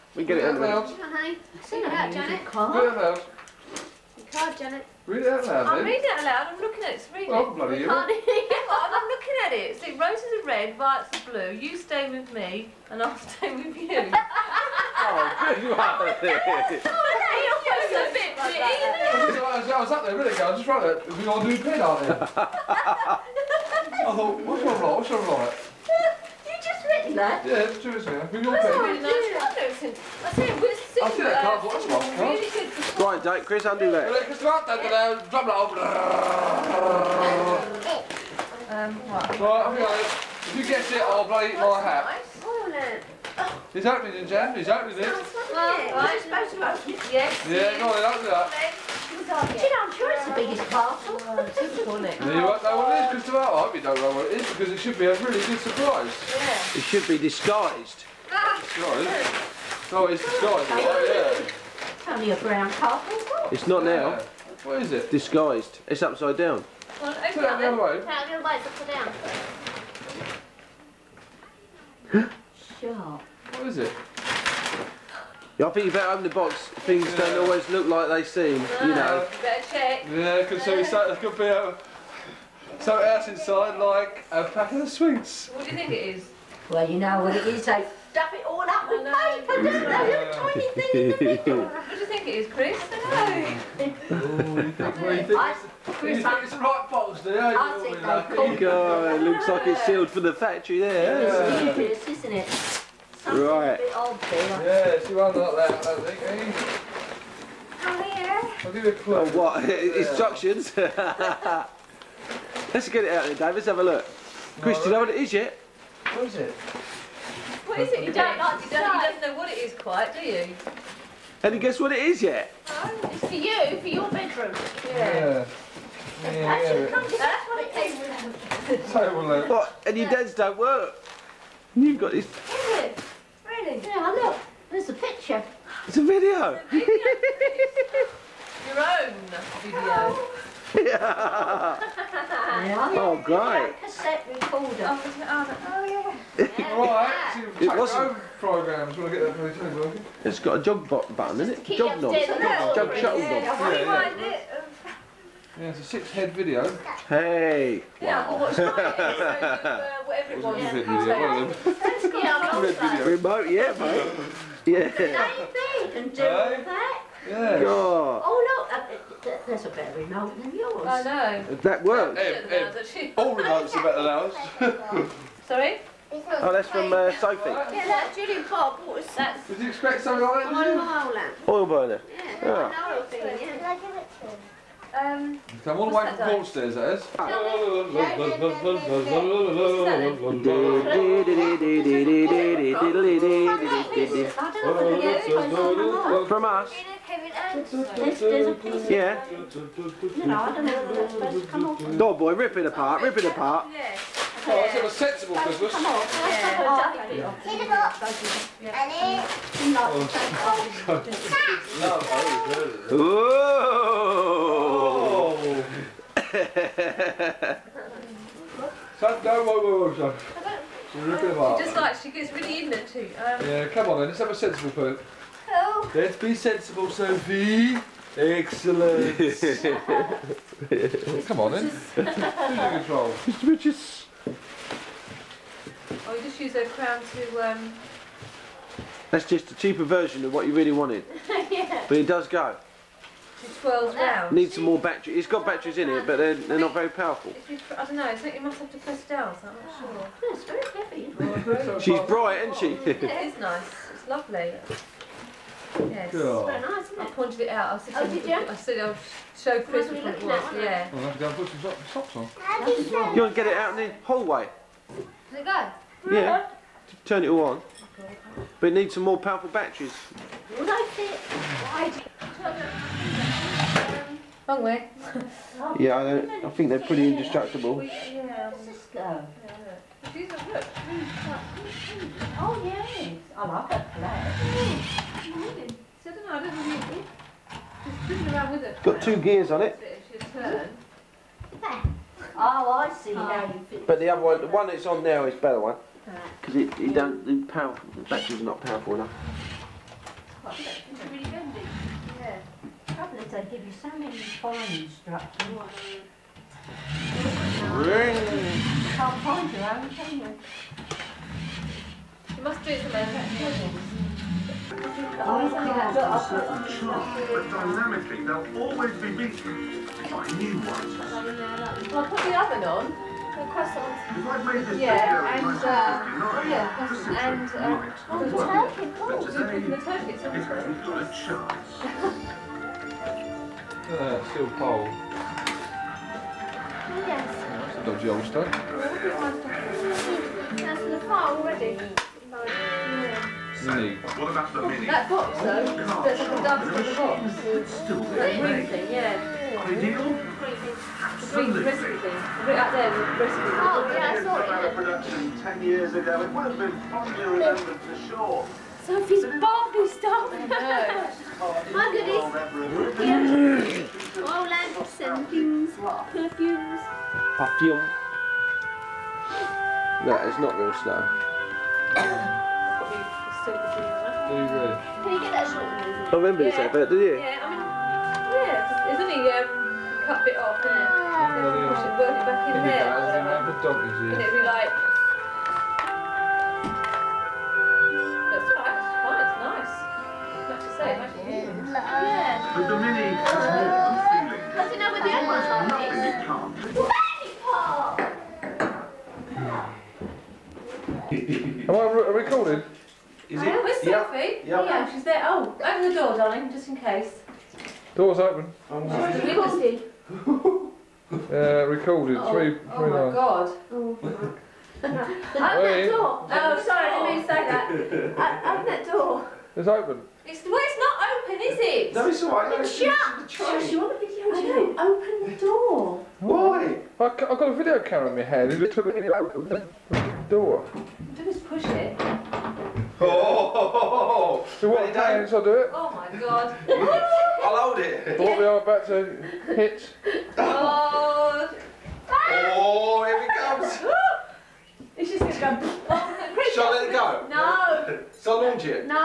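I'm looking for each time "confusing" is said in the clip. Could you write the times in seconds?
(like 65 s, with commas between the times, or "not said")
not said.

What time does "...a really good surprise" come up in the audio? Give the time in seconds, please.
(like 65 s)
55 s.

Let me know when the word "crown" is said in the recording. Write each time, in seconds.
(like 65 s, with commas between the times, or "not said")
236 s.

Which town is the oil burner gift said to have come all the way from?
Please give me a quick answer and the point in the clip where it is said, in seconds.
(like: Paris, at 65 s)
Broadstairs, at 186 s.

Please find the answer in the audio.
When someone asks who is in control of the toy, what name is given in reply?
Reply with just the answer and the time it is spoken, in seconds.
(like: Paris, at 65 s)
Mr. Richards, at 233 s.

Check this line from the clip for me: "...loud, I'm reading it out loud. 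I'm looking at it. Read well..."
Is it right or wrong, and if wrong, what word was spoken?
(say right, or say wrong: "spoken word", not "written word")
right.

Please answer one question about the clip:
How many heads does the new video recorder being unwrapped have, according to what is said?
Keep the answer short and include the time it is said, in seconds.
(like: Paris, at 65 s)
6, at 155 s.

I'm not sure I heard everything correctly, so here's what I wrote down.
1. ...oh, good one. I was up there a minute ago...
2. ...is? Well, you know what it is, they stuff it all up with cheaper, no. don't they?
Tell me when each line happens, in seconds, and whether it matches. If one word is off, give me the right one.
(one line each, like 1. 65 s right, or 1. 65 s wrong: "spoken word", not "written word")
1. 14 s right
2. 86 s wrong: "paper", not "cheaper".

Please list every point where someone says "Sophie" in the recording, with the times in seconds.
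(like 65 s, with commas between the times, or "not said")
177 s, 226 s, 358 s, 403 s.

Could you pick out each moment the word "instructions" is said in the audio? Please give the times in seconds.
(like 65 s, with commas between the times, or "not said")
109 s, 304 s.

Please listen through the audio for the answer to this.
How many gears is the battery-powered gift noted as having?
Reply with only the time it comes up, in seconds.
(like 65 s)
289 s.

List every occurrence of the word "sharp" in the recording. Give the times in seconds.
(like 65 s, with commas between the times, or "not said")
316 s.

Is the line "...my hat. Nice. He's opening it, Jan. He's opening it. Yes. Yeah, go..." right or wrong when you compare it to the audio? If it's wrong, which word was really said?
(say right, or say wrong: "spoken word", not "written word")
right.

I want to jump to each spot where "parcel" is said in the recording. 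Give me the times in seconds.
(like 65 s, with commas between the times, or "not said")
50 s, 62 s.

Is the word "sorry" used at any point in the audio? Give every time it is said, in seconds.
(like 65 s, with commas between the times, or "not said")
175 s, 416 s.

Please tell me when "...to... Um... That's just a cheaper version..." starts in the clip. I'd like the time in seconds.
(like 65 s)
237 s.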